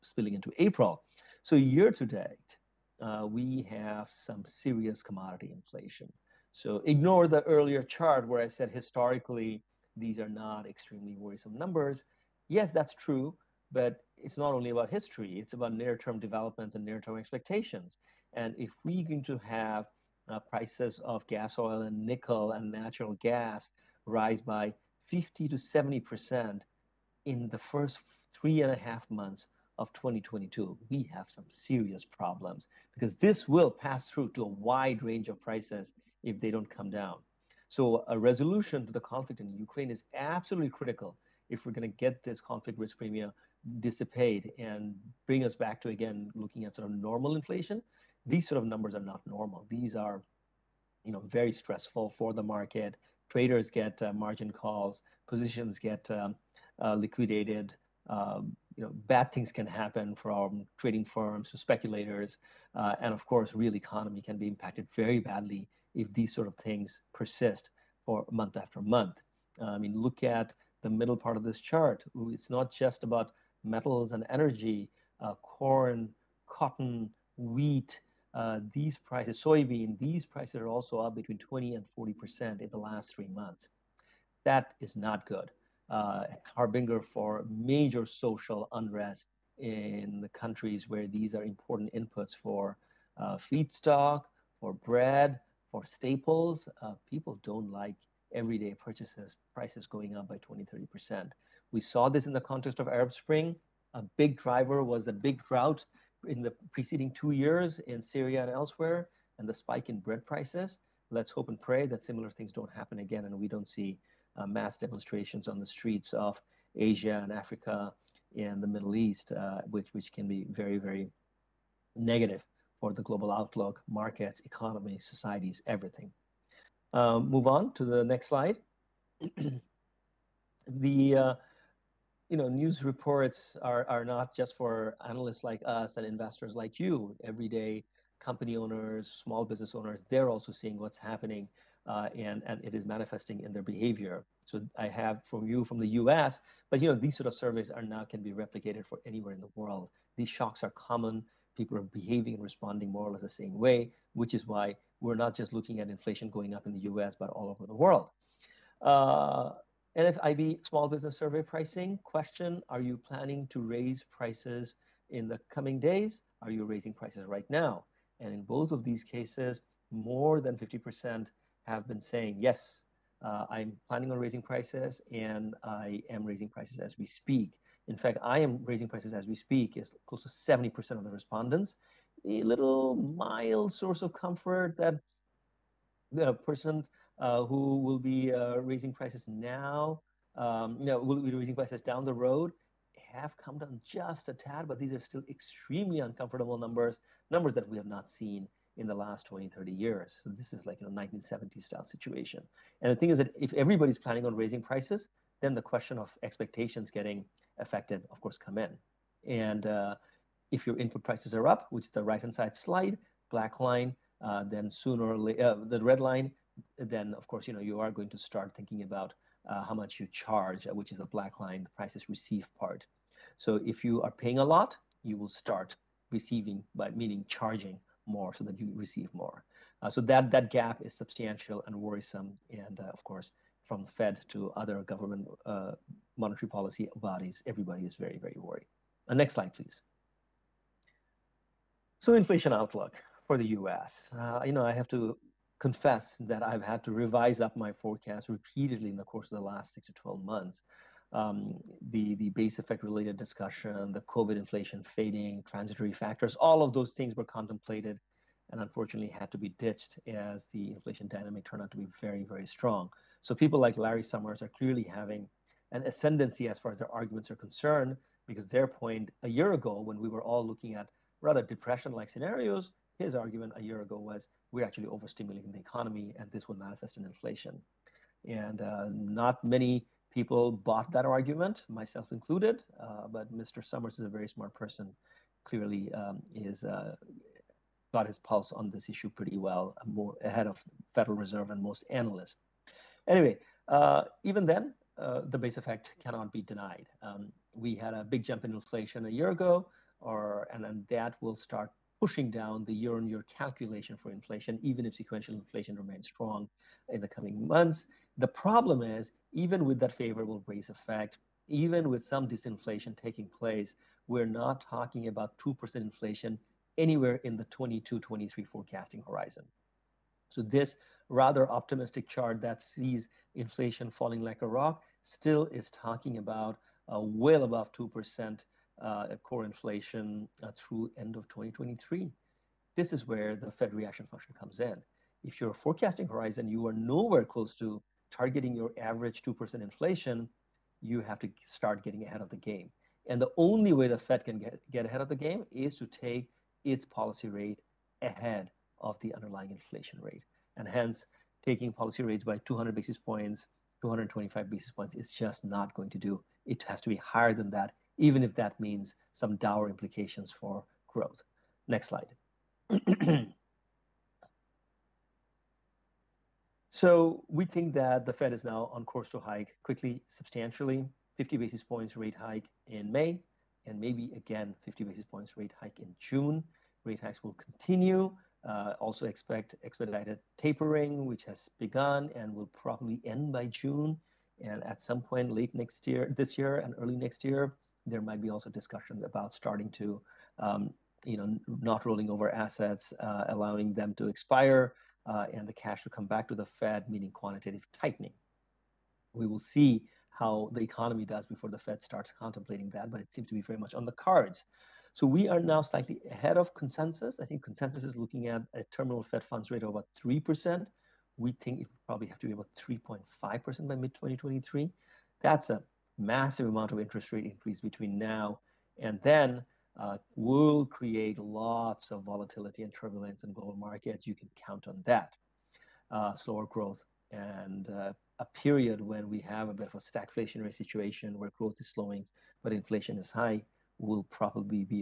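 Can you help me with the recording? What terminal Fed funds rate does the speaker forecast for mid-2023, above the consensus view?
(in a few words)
3.5%.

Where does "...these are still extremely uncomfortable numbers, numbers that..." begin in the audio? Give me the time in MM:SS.
03:14.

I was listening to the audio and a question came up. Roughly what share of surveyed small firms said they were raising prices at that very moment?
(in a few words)
close to 70%.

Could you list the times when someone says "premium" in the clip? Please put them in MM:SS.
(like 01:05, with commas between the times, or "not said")
00:42.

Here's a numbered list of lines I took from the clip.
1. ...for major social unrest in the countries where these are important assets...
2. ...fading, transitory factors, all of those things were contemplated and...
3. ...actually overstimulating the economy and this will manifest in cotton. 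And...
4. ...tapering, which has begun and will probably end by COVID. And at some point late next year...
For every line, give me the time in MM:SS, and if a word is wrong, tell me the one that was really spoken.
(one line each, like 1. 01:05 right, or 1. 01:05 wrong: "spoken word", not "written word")
1. 01:27 wrong: "inputs", not "assets"
2. 04:14 right
3. 04:34 wrong: "inflation", not "cotton"
4. 06:20 wrong: "June", not "COVID".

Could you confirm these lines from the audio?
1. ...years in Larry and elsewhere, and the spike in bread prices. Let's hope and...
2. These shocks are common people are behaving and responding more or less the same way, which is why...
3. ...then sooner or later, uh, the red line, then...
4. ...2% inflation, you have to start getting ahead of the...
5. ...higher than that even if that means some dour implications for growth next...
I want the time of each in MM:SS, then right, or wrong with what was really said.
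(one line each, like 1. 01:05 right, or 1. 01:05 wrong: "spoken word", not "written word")
1. 01:47 wrong: "Syria", not "Larry"
2. 02:30 right
3. 03:34 right
4. 05:39 right
5. 05:56 right.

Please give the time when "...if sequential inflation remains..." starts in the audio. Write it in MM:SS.
05:04.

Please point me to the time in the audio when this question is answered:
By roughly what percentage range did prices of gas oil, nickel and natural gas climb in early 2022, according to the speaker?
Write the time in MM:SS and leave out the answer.
00:25.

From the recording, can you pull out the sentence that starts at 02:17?
Everyday company owners, small business owners, they're also seeing what's happening, uh, and and it is manifesting in their behavior.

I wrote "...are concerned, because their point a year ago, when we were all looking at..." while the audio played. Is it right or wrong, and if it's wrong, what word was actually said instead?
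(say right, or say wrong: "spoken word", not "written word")
right.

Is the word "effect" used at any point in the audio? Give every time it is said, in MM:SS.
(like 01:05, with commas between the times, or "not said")
04:12, 04:55, 05:10.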